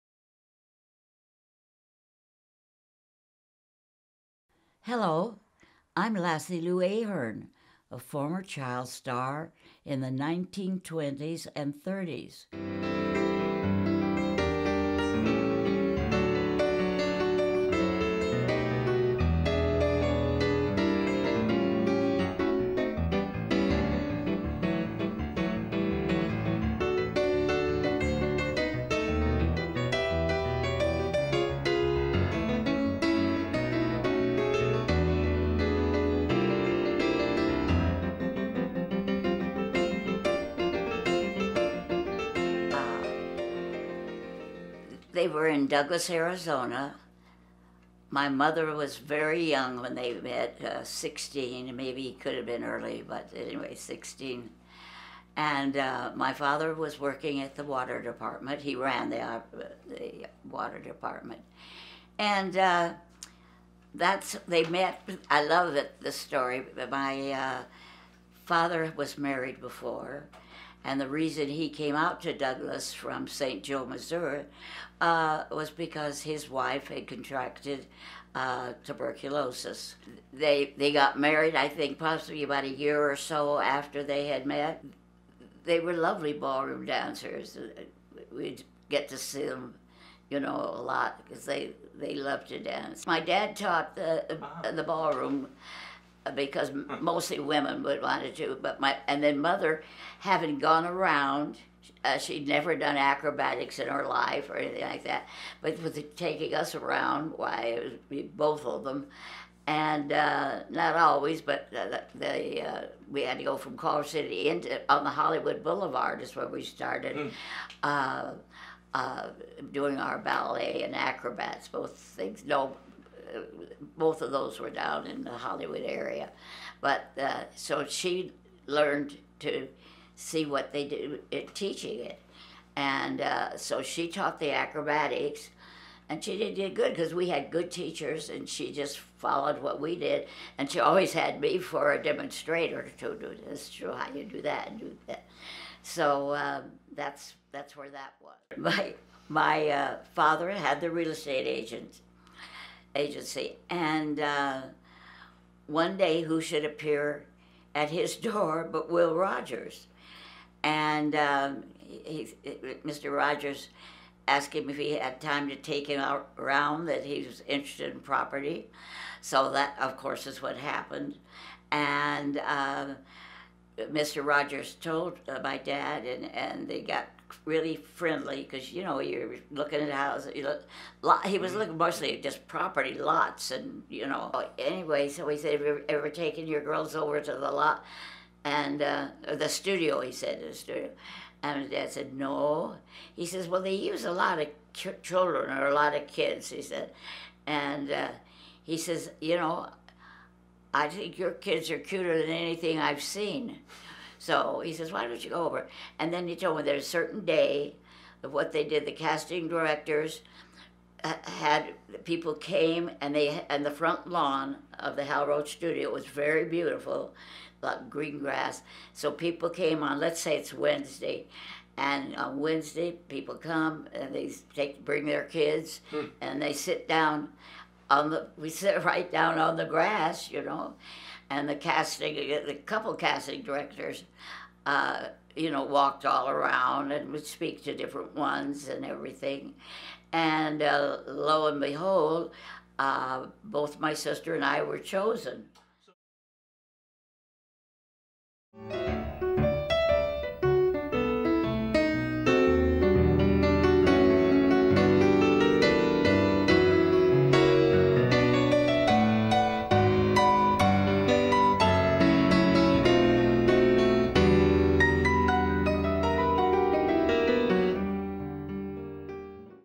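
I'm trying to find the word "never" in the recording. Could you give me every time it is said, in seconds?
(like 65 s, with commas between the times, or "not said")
102 s.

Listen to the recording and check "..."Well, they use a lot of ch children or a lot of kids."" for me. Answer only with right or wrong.
right.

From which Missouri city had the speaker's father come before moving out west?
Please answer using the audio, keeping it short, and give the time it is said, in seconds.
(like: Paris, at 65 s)
St. Joe, at 73 s.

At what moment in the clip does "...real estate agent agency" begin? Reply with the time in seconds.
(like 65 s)
150 s.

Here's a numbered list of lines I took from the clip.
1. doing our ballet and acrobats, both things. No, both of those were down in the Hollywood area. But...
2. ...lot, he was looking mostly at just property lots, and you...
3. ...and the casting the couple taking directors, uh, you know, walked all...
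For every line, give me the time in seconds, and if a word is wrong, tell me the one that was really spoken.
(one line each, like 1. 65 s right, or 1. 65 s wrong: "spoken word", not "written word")
1. 119 s right
2. 181 s right
3. 231 s wrong: "casting", not "taking".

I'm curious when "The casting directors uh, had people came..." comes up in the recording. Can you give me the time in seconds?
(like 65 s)
208 s.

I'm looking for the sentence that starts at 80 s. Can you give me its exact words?
They, they got married, I think, possibly about a year or so after they had met.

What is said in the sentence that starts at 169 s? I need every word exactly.
So that, of course, is what happened.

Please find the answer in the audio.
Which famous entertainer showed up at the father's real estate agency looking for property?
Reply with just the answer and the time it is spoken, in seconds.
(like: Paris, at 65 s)
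Will Rogers, at 158 s.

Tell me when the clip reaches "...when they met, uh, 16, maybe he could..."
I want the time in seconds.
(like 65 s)
49 s.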